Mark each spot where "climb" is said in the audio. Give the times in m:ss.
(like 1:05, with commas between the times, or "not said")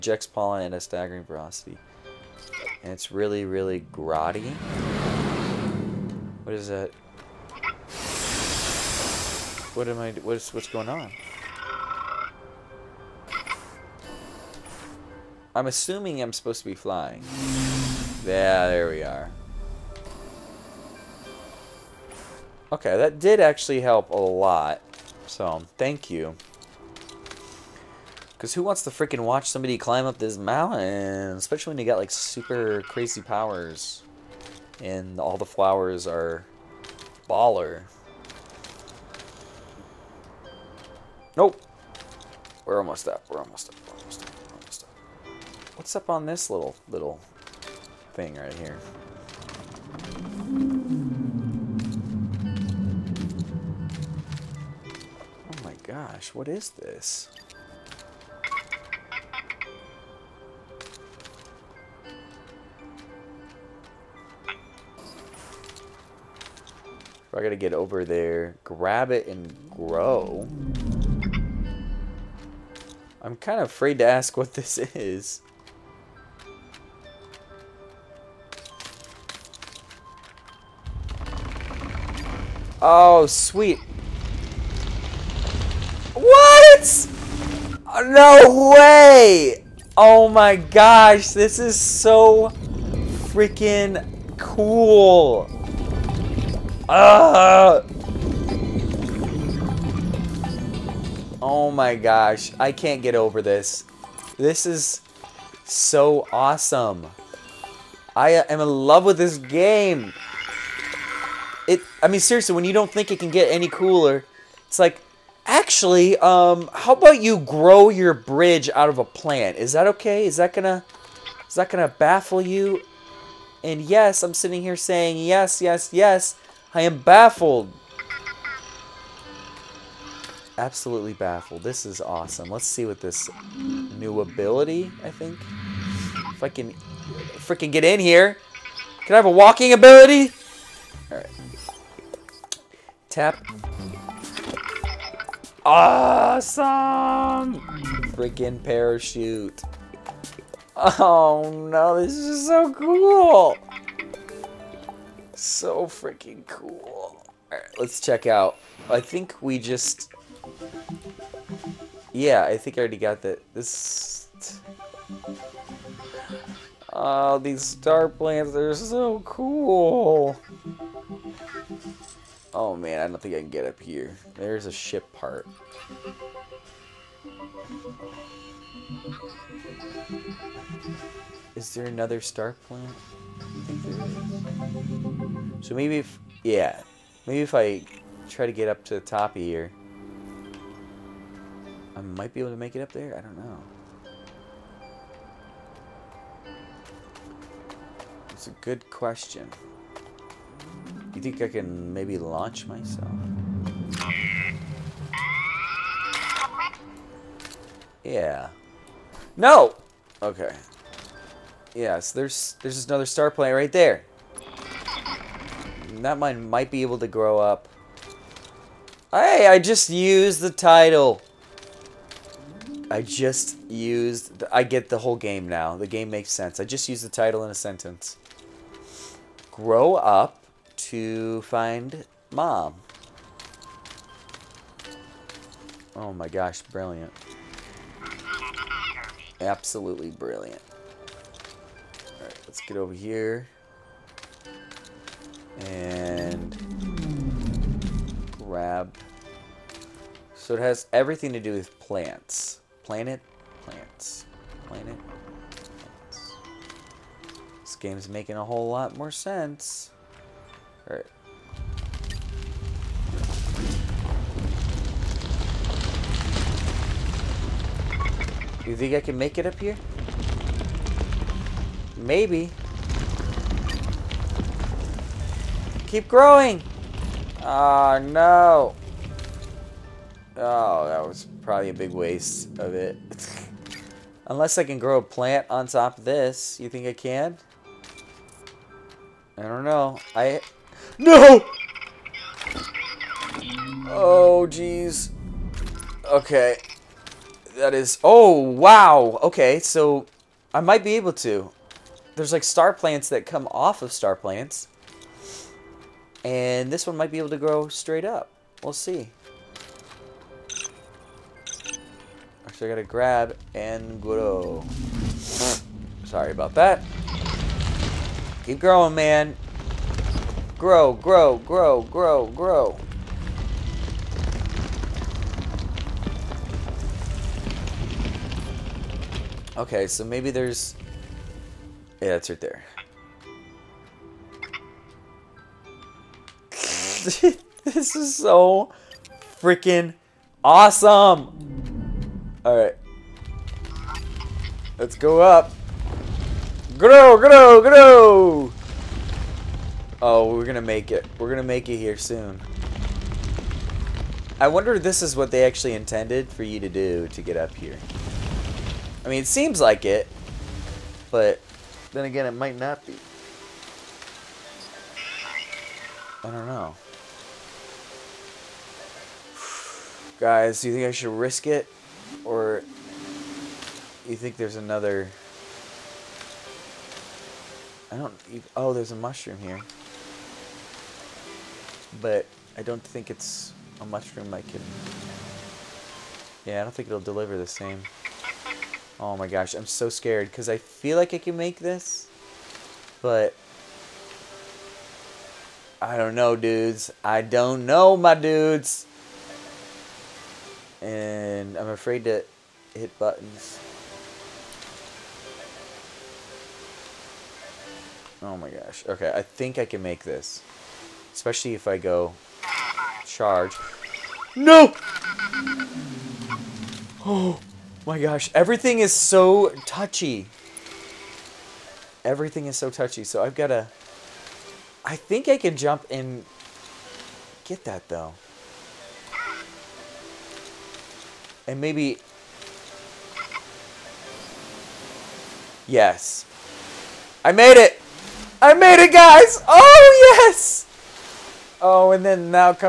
0:29.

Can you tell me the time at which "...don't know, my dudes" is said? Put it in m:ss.
6:37.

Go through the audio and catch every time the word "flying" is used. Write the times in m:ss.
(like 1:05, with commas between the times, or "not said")
0:16.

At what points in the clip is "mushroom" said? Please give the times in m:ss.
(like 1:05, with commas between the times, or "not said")
6:18, 6:23.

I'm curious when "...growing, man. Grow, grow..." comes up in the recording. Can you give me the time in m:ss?
5:18.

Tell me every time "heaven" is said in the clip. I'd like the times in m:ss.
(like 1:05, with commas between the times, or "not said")
not said.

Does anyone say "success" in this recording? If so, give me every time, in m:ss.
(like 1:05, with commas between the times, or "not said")
not said.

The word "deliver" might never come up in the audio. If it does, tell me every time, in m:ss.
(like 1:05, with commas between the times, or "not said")
6:26.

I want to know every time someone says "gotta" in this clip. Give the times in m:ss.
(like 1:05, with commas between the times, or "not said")
1:07, 5:12.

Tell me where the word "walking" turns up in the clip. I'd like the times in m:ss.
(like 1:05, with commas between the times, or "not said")
2:19.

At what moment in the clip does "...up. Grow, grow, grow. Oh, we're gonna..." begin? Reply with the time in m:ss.
5:45.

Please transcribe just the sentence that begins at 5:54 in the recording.
I wonder if this is what they actually intended for you to do to get up here.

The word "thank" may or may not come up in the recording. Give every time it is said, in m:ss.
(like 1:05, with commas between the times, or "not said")
0:25.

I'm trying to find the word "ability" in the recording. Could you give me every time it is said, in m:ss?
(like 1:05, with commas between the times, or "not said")
2:14, 2:19.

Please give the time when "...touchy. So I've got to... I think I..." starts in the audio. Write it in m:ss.
7:02.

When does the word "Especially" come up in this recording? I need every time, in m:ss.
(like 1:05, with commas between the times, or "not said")
0:31, 6:51.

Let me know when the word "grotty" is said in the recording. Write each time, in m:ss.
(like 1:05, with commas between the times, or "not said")
0:03.